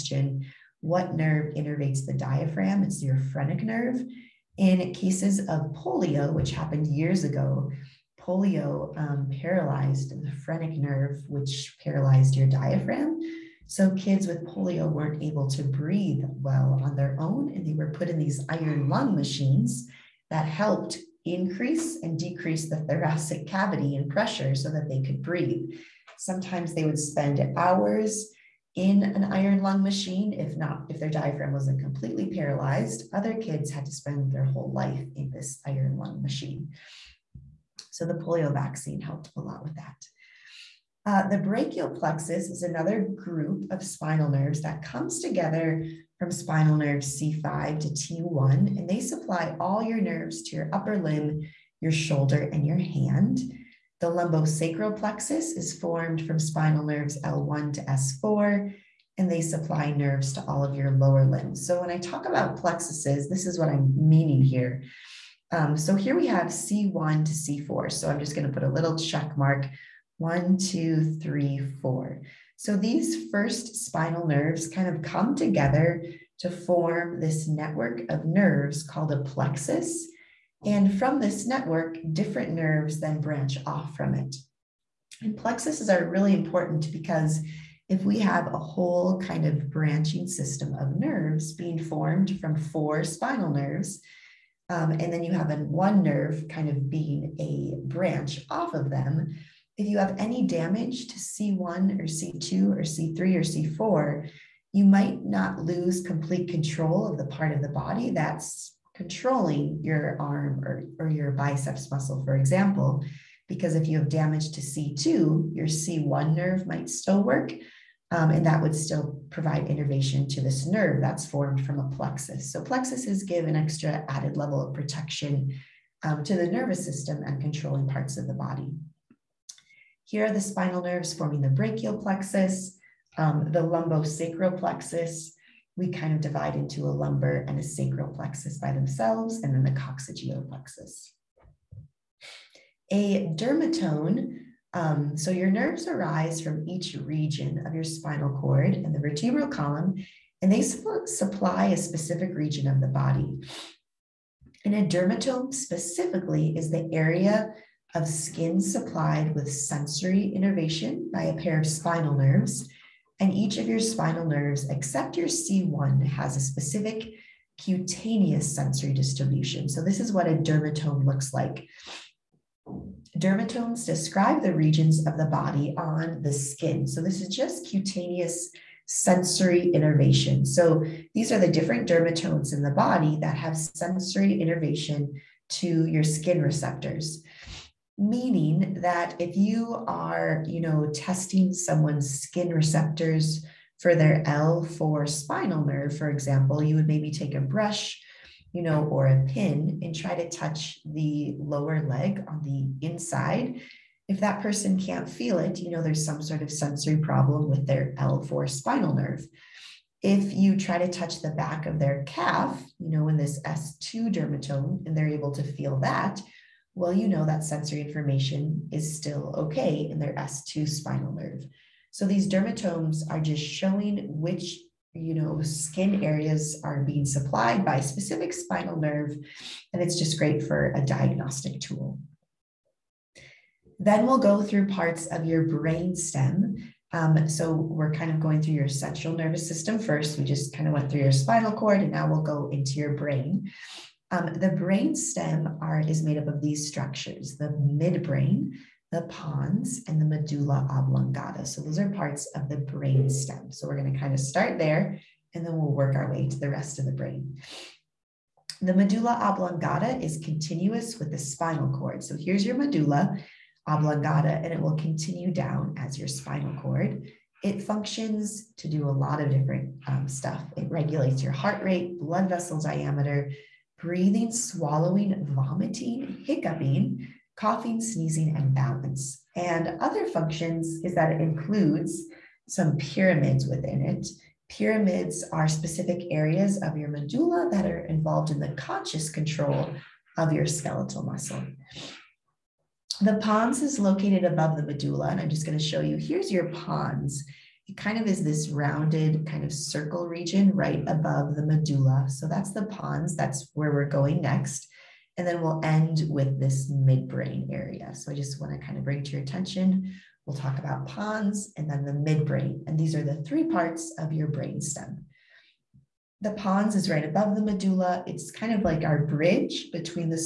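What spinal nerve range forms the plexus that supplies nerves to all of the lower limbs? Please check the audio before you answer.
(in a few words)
L1 to S4.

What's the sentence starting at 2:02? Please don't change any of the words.
So plexuses give an extra added level of protection um, to the nervous system and controlling parts of the body.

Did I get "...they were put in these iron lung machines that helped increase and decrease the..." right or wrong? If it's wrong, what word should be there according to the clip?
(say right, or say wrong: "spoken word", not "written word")
right.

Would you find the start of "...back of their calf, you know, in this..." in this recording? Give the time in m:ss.
3:31.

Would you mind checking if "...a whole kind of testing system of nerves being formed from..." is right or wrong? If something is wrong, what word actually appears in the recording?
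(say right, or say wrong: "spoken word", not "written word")
wrong: "branching", not "testing".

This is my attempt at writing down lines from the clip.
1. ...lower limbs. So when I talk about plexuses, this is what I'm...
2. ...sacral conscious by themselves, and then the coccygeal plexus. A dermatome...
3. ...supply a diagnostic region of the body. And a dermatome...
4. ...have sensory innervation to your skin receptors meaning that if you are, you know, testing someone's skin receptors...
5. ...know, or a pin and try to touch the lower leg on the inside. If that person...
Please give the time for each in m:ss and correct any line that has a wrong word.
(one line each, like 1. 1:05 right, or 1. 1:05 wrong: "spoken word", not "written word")
1. 1:00 right
2. 2:17 wrong: "plexus", not "conscious"
3. 2:31 wrong: "specific", not "diagnostic"
4. 3:03 right
5. 3:18 right.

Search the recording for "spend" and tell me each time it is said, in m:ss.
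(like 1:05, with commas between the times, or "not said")
0:26, 0:33.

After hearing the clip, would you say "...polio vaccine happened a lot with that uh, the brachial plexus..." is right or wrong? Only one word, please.
wrong.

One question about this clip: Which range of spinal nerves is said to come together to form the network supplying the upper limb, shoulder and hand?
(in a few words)
C5 to T1.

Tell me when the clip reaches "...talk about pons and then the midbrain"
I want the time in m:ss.
5:10.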